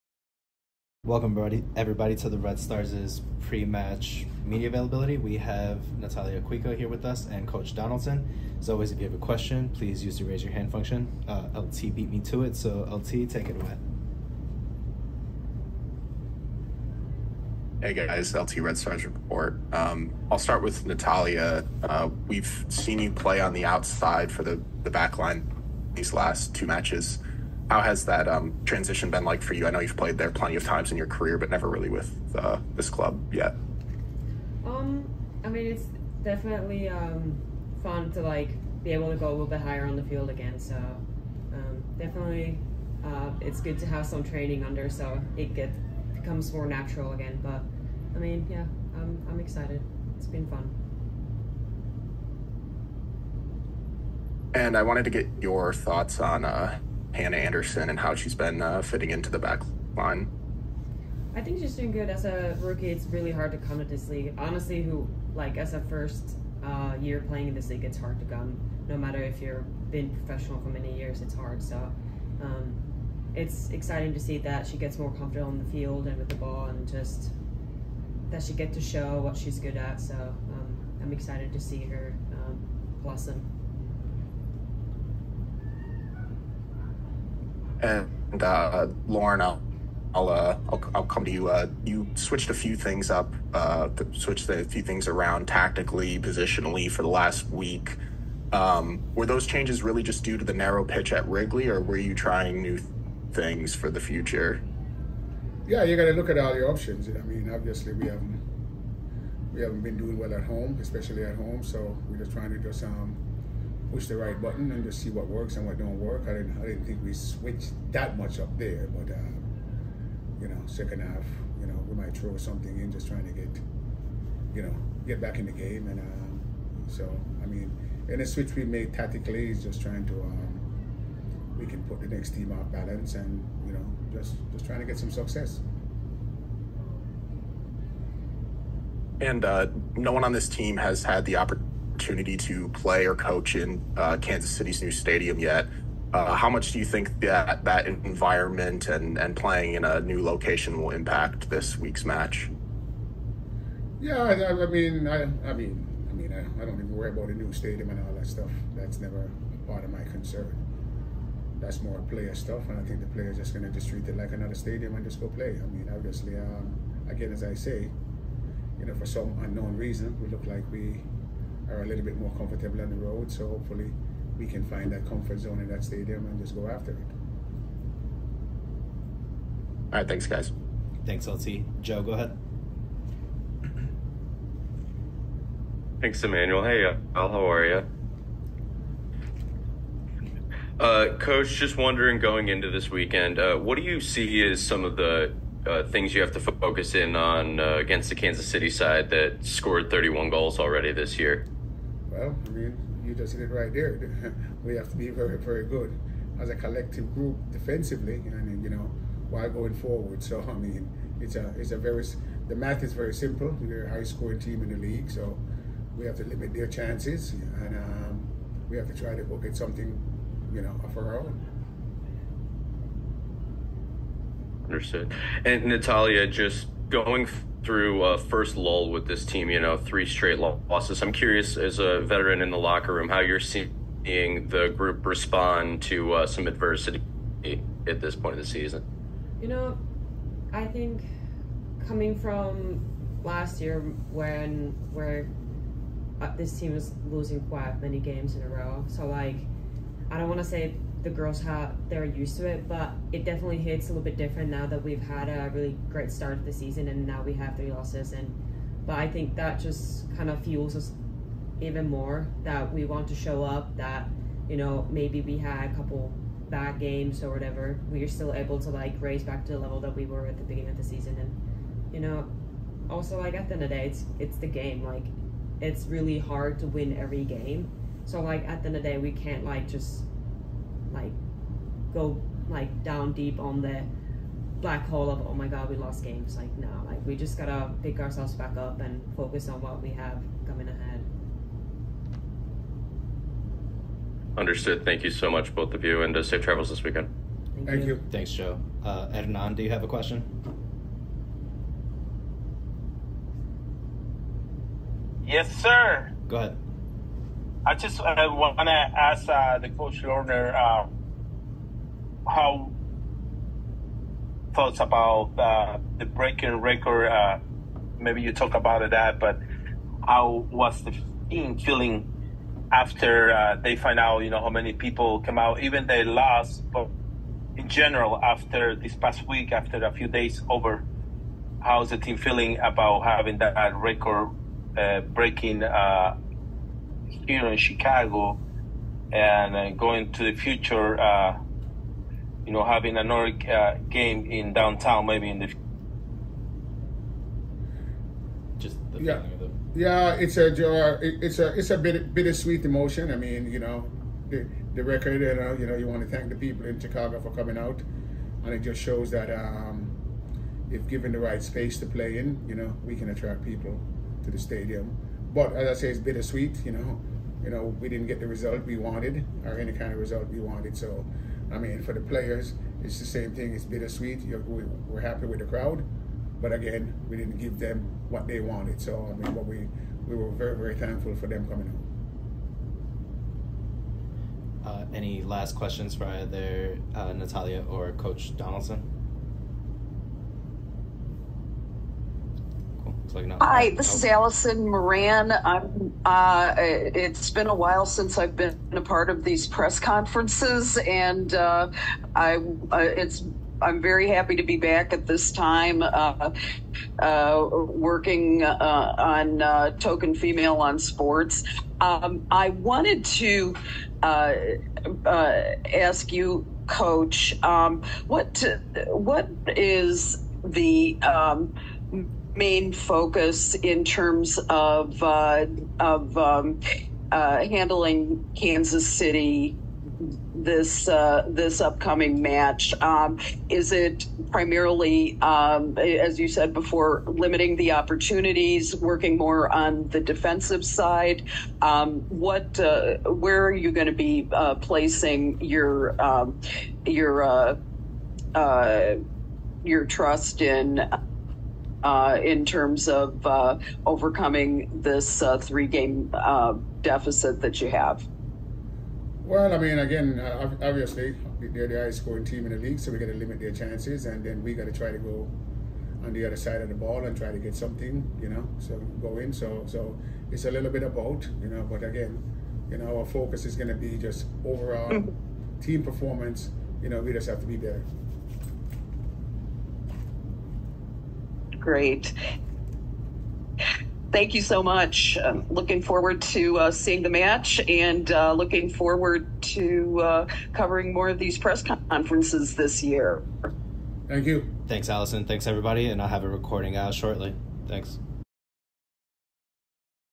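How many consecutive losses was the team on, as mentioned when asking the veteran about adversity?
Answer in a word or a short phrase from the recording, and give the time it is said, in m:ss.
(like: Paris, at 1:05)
3, at 3:49.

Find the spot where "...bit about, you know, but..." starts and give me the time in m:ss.
7:50.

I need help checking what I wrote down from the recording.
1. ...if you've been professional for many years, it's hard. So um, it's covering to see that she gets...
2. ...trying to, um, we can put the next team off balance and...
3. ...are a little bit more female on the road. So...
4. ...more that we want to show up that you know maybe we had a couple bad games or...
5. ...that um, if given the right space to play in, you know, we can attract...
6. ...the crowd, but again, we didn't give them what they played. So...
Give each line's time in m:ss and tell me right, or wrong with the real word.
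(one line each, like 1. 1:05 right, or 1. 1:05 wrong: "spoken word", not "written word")
1. 1:09 wrong: "exciting", not "covering"
2. 2:09 right
3. 2:51 wrong: "comfortable", not "female"
4. 4:21 right
5. 5:59 right
6. 6:15 wrong: "wanted", not "played".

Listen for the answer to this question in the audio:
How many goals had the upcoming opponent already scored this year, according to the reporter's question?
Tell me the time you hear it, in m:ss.
3:19.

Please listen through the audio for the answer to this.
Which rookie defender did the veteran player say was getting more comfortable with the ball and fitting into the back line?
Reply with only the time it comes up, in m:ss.
0:57.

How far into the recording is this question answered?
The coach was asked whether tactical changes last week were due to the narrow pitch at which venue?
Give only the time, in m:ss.
1:41.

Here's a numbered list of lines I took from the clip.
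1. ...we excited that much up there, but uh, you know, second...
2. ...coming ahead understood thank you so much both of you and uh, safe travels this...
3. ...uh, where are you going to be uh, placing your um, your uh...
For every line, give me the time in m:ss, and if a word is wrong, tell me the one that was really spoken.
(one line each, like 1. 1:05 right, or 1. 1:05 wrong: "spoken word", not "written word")
1. 1:57 wrong: "switched", not "excited"
2. 4:50 right
3. 7:22 right.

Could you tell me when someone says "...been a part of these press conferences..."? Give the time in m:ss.
6:38.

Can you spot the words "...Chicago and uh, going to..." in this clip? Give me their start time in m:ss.
5:37.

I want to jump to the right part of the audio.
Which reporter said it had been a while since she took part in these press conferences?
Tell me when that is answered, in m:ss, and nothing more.
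6:34.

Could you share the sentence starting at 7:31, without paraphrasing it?
Uh, in terms of uh, overcoming this uh, three game uh, deficit that you have?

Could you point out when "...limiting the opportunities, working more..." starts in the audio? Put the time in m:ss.
7:17.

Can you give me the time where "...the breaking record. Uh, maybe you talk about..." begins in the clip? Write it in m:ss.
5:15.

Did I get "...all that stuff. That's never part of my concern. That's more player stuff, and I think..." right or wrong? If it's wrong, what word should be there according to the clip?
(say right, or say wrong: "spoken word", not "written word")
right.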